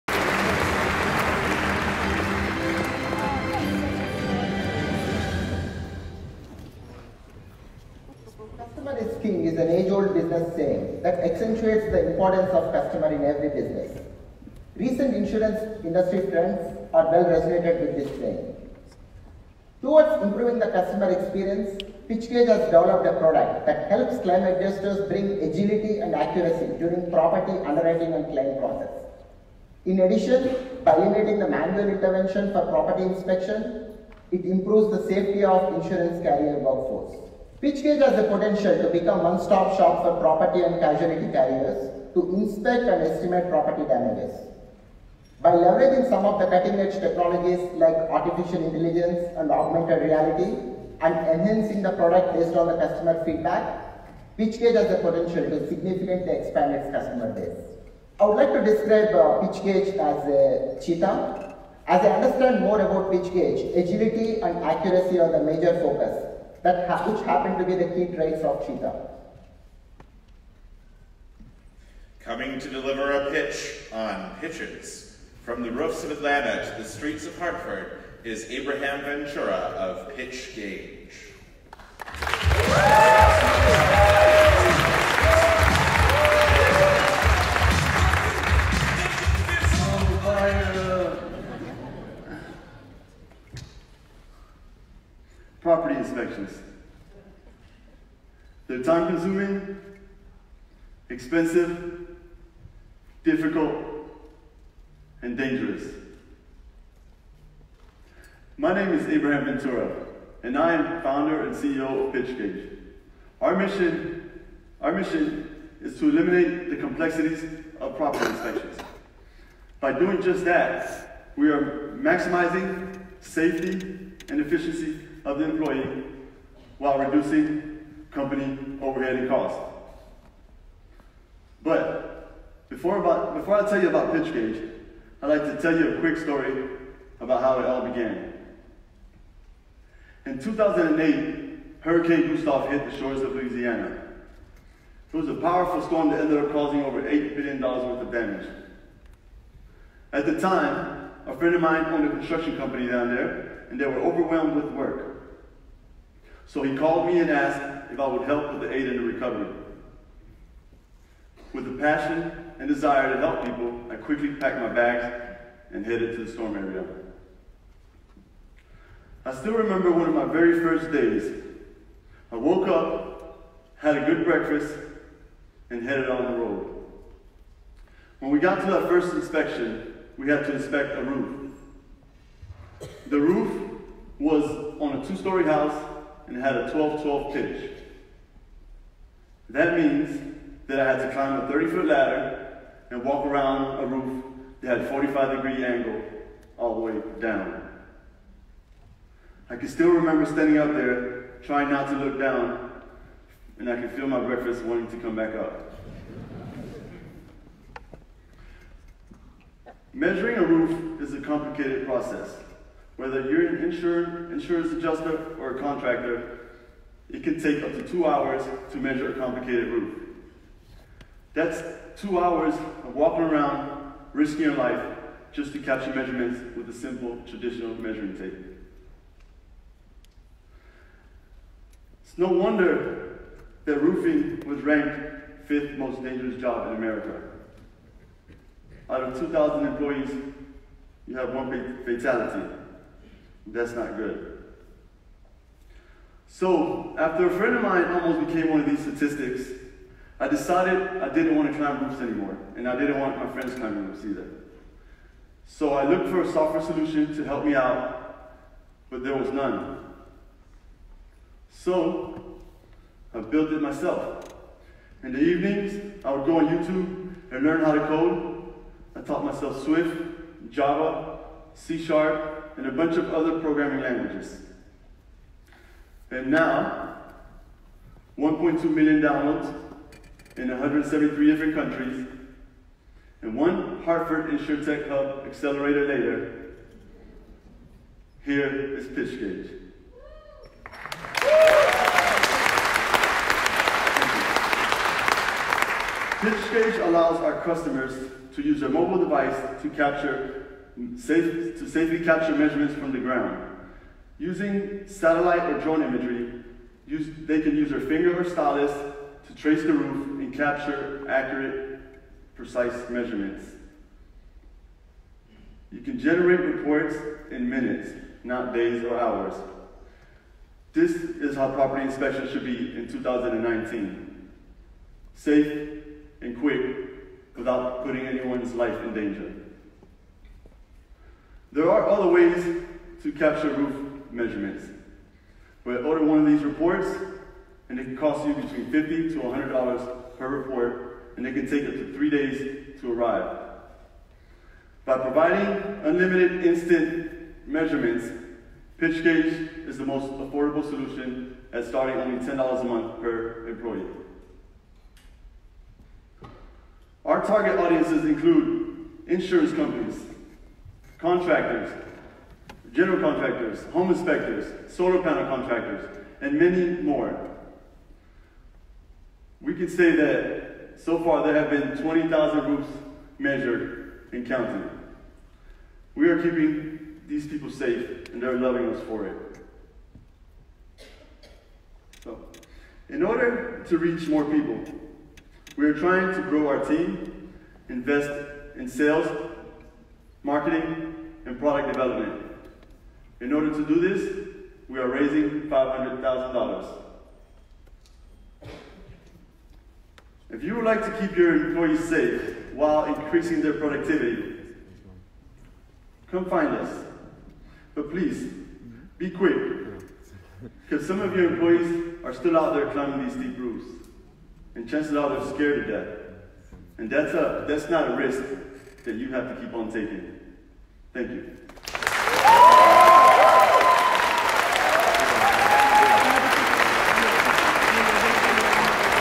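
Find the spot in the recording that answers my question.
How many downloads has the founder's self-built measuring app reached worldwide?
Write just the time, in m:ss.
4:38.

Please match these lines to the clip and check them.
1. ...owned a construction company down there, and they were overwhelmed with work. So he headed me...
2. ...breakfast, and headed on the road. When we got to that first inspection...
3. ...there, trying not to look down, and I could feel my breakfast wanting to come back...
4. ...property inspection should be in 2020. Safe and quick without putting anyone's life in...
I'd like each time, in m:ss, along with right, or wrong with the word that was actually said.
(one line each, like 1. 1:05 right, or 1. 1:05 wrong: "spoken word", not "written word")
1. 2:31 wrong: "called", not "headed"
2. 2:54 right
3. 3:20 right
4. 5:21 wrong: "2019", not "2020".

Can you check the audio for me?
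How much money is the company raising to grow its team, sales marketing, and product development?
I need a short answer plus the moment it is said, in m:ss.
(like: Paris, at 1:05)
$500,000, at 6:35.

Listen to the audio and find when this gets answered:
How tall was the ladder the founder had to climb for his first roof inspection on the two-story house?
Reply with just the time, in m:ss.
3:11.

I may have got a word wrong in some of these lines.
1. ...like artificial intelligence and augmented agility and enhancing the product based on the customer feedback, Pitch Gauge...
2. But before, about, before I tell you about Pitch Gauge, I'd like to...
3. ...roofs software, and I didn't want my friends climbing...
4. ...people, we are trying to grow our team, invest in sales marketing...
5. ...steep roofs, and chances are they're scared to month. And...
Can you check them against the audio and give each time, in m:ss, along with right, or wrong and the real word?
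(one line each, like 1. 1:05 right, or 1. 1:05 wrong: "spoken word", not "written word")
1. 0:47 wrong: "reality", not "agility"
2. 2:11 right
3. 4:11 wrong: "anymore", not "software"
4. 6:24 right
5. 6:53 wrong: "death", not "month".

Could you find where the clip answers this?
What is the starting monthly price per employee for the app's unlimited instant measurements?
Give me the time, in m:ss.
5:52.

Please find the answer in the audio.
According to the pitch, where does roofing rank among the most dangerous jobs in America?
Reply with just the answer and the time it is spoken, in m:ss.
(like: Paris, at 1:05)
fifth, at 3:55.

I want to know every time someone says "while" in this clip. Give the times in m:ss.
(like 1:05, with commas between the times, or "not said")
2:06, 6:42.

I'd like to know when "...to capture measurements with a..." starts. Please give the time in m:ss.
3:45.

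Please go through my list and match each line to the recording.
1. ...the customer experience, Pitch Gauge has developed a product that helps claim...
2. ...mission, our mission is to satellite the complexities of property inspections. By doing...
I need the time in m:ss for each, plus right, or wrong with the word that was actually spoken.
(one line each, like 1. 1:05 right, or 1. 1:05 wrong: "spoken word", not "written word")
1. 0:20 right
2. 1:53 wrong: "eliminate", not "satellite".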